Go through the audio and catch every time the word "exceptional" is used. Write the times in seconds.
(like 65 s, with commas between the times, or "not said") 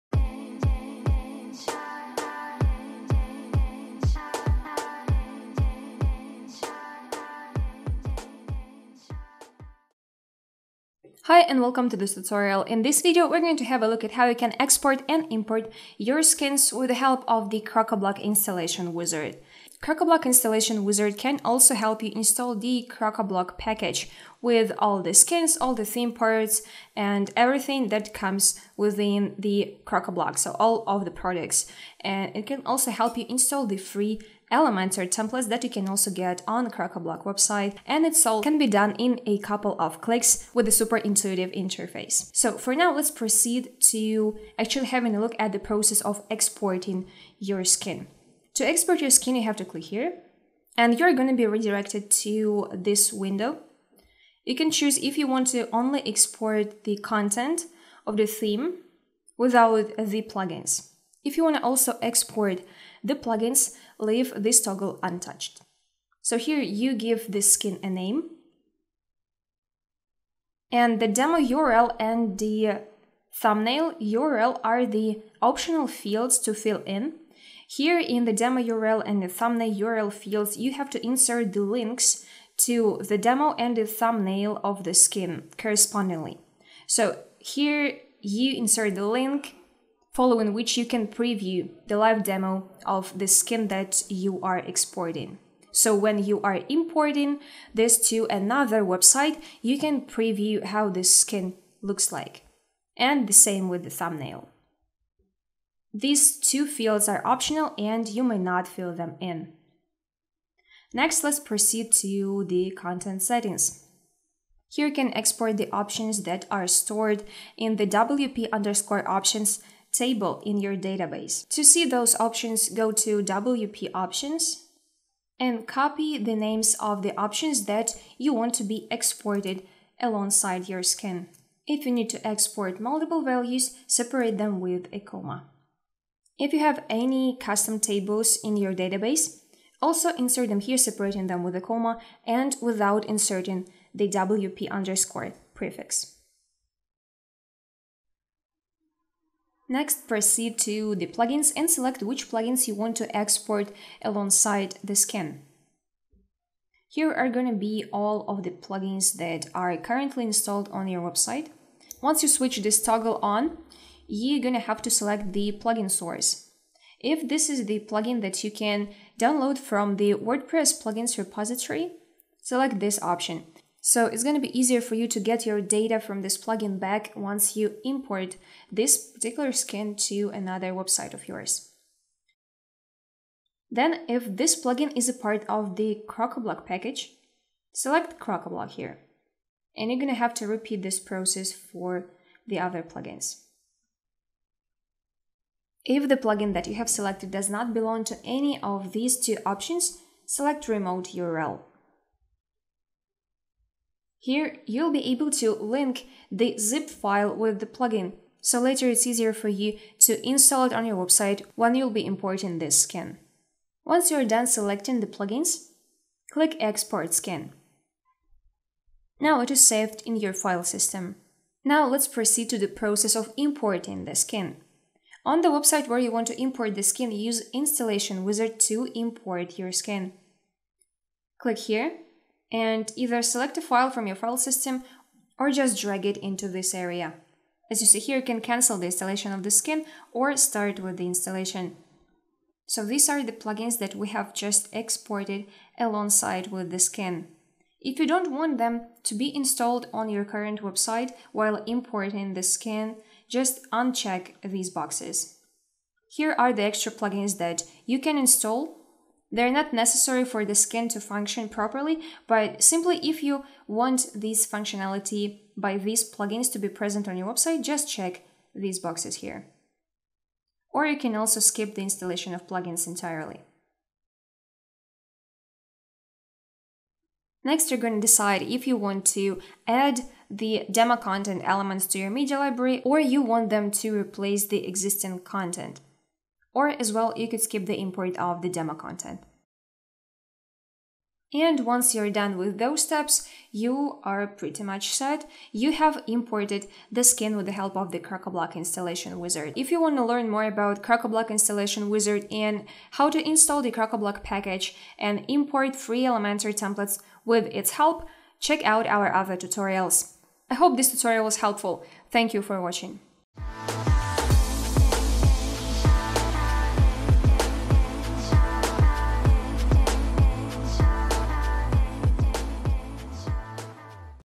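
not said.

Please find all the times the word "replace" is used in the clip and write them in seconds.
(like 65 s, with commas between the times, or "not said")
283 s.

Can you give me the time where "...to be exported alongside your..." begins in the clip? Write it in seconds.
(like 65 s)
128 s.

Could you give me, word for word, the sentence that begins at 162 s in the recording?
Once you switch this toggle on, you're gonna have to select the plugin source.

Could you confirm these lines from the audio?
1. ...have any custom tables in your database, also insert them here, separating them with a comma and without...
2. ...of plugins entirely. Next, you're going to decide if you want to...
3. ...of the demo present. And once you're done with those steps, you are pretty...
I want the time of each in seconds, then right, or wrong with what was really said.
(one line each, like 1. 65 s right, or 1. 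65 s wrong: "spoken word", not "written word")
1. 136 s right
2. 272 s right
3. 288 s wrong: "content", not "present".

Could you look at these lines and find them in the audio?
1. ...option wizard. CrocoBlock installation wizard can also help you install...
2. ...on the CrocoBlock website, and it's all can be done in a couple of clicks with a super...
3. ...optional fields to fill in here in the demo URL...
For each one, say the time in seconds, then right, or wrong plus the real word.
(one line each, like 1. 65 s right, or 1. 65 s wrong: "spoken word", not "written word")
1. 18 s wrong: "installation", not "option"
2. 36 s right
3. 75 s right.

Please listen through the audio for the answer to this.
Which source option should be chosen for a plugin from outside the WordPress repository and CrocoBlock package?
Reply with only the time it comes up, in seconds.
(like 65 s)
200 s.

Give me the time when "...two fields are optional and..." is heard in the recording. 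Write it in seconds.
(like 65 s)
106 s.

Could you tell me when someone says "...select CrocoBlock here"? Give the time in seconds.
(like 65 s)
187 s.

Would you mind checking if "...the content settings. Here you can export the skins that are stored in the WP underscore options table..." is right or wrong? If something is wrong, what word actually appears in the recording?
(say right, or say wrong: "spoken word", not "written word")
wrong: "options", not "skins".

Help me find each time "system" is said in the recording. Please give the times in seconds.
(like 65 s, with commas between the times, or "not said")
220 s, 234 s.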